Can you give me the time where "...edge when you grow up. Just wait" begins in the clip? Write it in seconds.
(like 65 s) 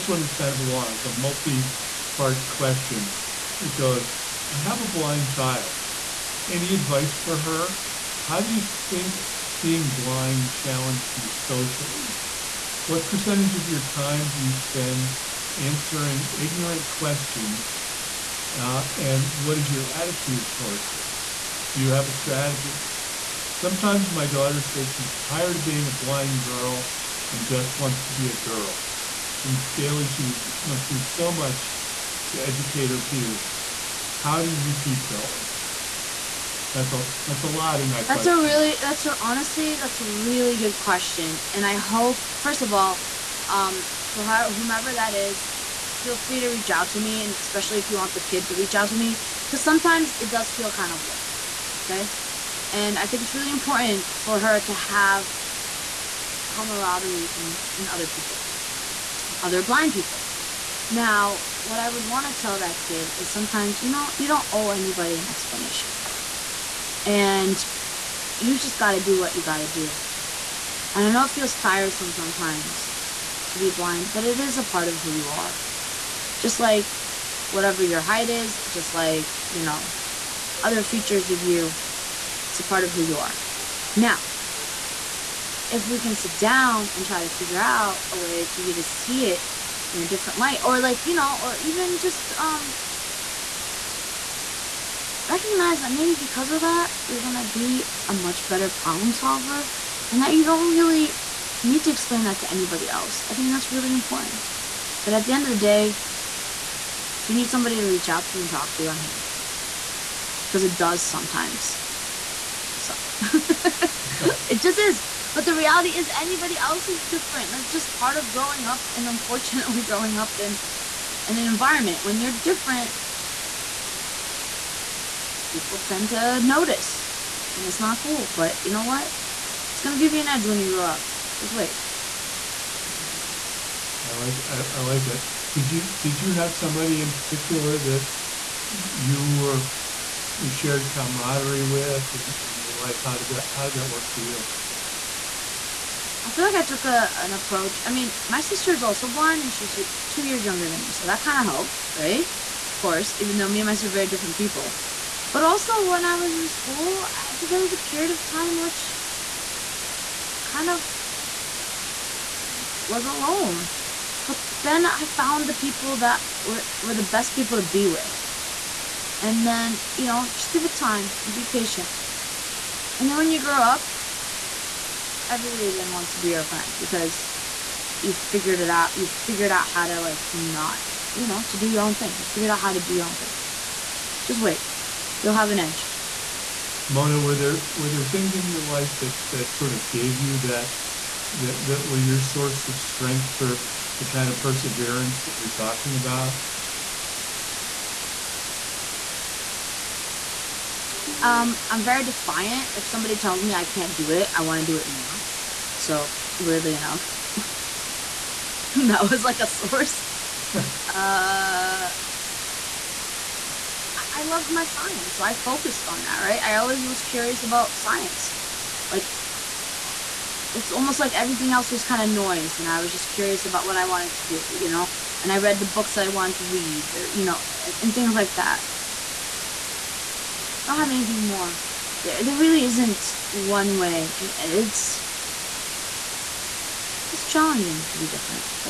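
130 s.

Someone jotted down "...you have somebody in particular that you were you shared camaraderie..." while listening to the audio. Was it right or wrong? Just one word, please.
right.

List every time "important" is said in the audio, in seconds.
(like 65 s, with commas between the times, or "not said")
53 s, 103 s.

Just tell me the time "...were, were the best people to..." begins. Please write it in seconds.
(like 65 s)
166 s.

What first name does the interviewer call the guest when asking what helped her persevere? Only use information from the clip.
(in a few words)
Mona.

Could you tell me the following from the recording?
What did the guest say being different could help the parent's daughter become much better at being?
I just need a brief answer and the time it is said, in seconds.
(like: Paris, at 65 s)
problem solver, at 98 s.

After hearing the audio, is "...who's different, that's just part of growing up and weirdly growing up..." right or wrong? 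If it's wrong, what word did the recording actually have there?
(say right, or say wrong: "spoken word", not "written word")
wrong: "unfortunately", not "weirdly".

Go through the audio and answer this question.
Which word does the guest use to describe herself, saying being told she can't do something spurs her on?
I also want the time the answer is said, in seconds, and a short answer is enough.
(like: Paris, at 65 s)
defiant, at 202 s.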